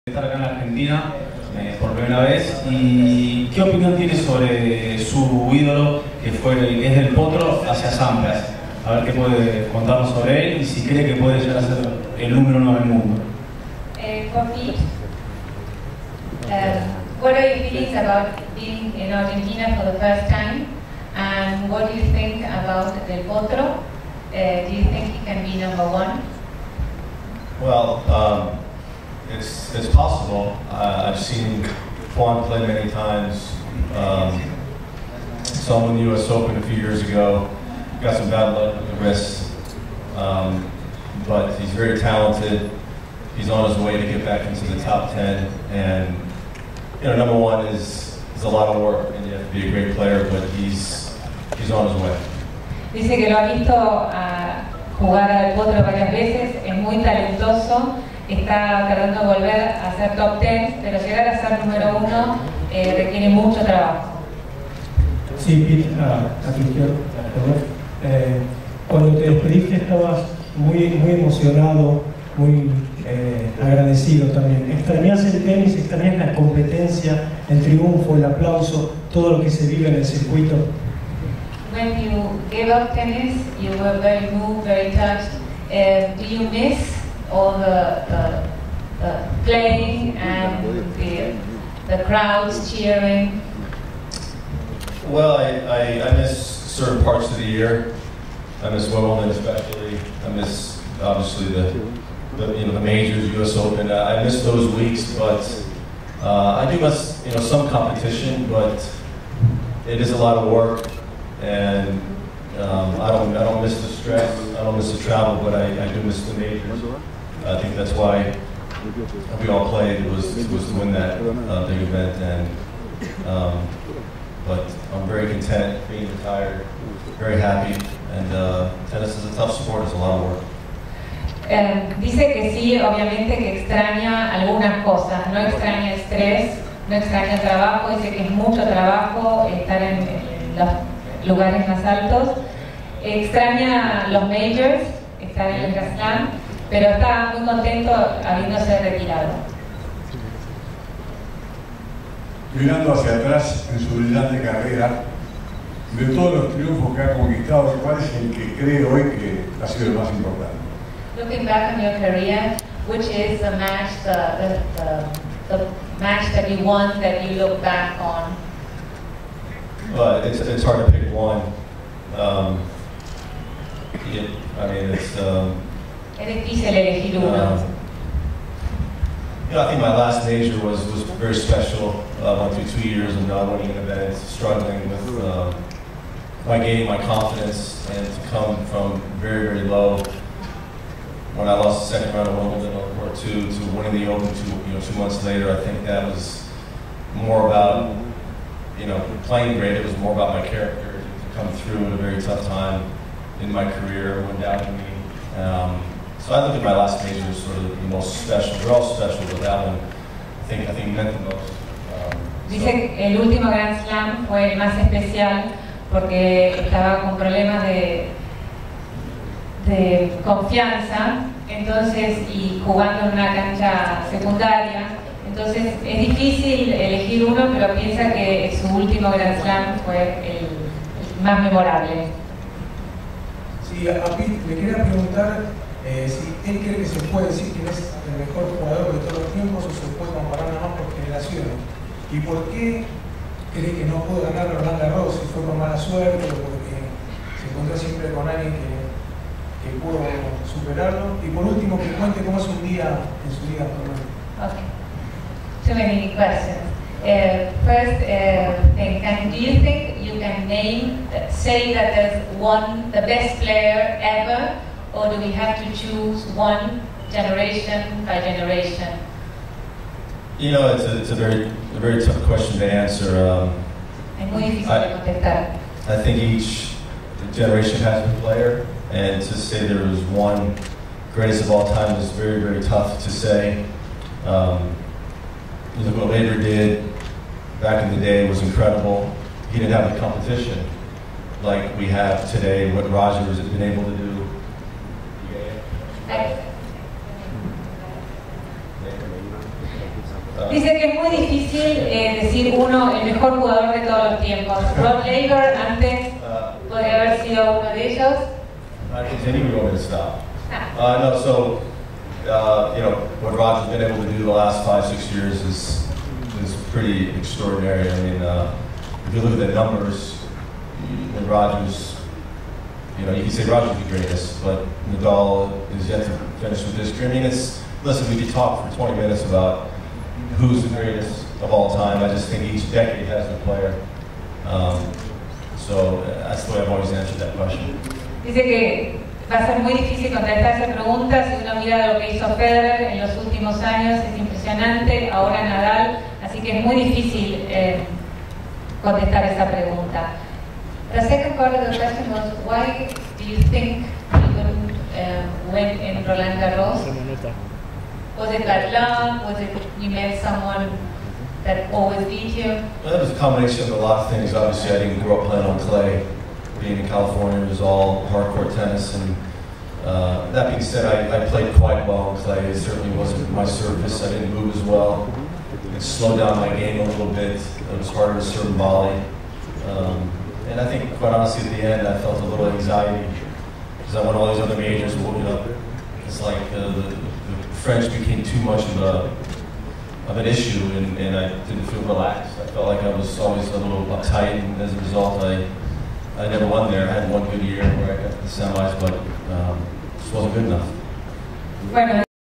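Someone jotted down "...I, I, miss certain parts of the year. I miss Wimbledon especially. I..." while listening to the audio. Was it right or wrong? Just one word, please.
right.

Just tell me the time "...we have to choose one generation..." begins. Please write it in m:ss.
4:25.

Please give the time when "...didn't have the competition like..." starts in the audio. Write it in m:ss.
4:49.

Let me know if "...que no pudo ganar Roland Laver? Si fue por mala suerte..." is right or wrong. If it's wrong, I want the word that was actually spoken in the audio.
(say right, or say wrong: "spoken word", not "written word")
wrong: "Garros", not "Laver".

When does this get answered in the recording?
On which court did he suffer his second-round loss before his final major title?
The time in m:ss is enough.
3:12.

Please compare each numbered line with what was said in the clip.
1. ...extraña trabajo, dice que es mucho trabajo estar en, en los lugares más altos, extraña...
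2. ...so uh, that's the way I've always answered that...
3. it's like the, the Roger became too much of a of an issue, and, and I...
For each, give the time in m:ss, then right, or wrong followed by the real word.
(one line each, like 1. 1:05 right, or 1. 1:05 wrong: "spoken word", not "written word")
1. 2:16 right
2. 5:35 right
3. 6:26 wrong: "French", not "Roger".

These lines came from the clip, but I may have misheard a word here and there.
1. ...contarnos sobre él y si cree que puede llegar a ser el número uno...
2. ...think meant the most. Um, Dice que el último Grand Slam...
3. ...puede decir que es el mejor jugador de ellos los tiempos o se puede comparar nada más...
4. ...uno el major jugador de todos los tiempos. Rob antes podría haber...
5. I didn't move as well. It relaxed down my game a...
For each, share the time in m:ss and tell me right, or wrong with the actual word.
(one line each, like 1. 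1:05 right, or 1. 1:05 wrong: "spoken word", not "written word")
1. 0:09 right
2. 3:30 right
3. 3:57 wrong: "todos", not "ellos"
4. 5:02 wrong: "mejor", not "major"
5. 6:14 wrong: "slowed", not "relaxed".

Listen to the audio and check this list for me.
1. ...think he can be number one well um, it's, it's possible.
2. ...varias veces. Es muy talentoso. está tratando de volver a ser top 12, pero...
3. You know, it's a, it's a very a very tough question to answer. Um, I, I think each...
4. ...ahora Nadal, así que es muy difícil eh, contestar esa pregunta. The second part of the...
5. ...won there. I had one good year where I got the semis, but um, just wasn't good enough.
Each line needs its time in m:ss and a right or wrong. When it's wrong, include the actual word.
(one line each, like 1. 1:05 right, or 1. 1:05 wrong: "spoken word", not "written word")
1. 0:24 right
2. 0:55 wrong: "10", not "12"
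3. 4:30 right
4. 5:45 right
5. 6:36 right.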